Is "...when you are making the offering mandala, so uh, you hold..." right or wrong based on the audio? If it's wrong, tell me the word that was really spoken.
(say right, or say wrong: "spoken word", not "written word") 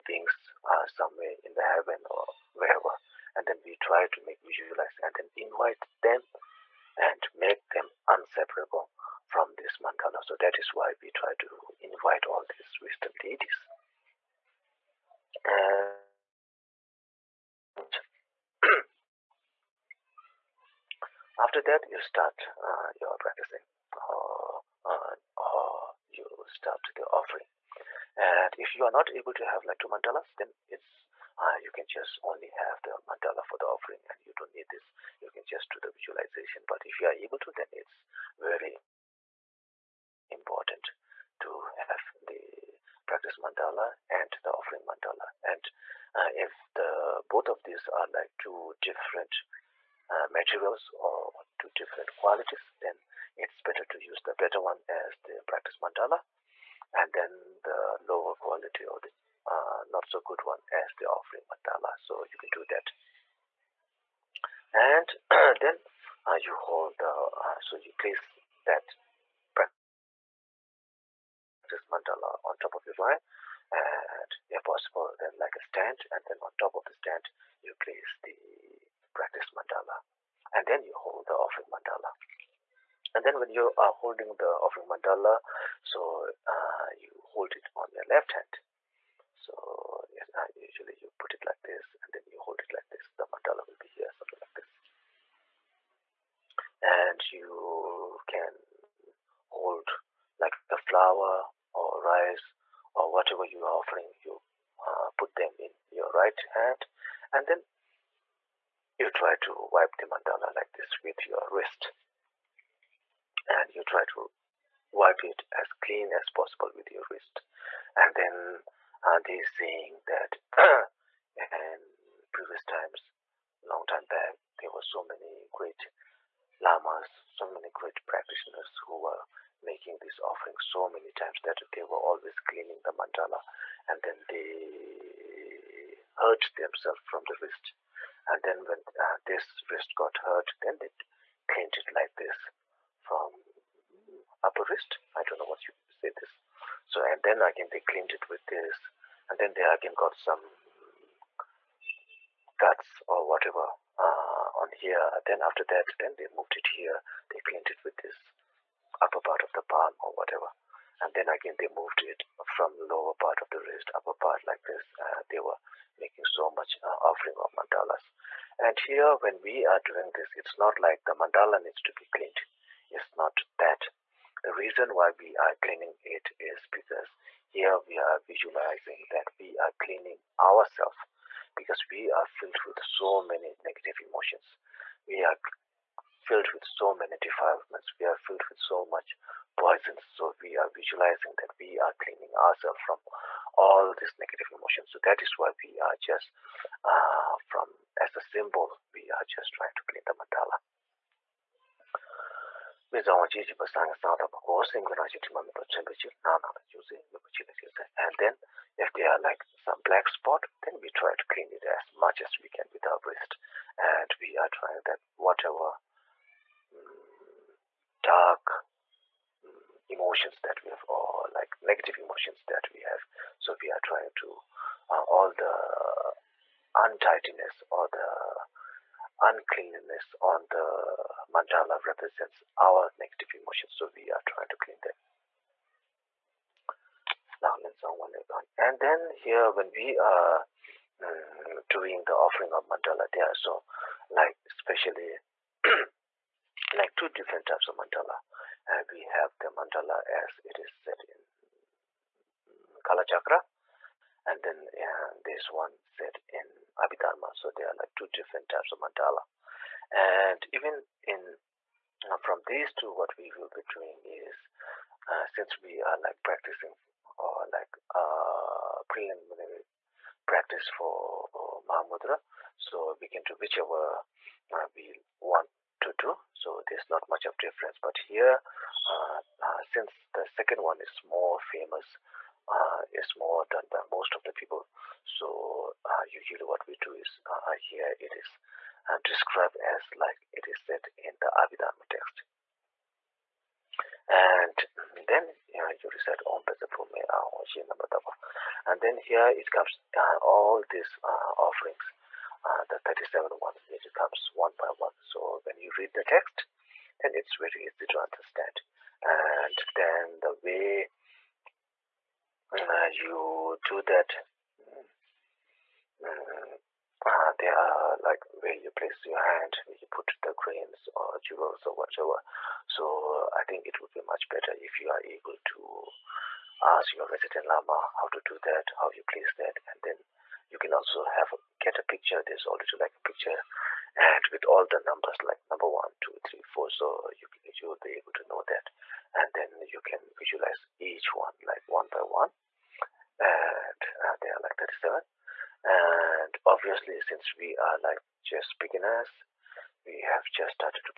wrong: "holding", not "making".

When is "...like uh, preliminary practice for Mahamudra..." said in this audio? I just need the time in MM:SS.
04:27.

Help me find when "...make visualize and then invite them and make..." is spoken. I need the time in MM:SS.
00:04.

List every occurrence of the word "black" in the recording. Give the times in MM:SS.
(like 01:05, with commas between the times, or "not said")
03:29.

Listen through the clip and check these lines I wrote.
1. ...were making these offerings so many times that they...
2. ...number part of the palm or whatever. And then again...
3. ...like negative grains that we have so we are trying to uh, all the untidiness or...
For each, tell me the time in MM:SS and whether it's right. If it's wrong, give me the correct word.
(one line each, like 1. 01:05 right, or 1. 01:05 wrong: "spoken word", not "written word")
1. 02:08 right
2. 02:39 wrong: "upper", not "number"
3. 03:41 wrong: "emotions", not "grains".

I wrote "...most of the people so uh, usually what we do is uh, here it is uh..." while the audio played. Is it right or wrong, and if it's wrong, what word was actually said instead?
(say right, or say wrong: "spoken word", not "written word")
right.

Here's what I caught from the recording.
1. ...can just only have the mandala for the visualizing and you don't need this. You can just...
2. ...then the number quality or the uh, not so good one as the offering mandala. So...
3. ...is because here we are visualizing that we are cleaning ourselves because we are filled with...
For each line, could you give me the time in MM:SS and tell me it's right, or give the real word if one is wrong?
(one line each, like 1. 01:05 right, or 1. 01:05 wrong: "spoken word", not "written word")
1. 00:31 wrong: "offering", not "visualizing"
2. 00:57 wrong: "lower", not "number"
3. 02:56 right.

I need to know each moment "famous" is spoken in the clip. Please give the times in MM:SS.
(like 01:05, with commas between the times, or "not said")
04:41.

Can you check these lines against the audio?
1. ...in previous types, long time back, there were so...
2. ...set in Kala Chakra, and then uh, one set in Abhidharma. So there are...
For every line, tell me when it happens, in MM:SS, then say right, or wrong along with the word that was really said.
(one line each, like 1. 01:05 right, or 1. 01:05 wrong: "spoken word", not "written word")
1. 02:01 wrong: "times", not "types"
2. 04:10 right.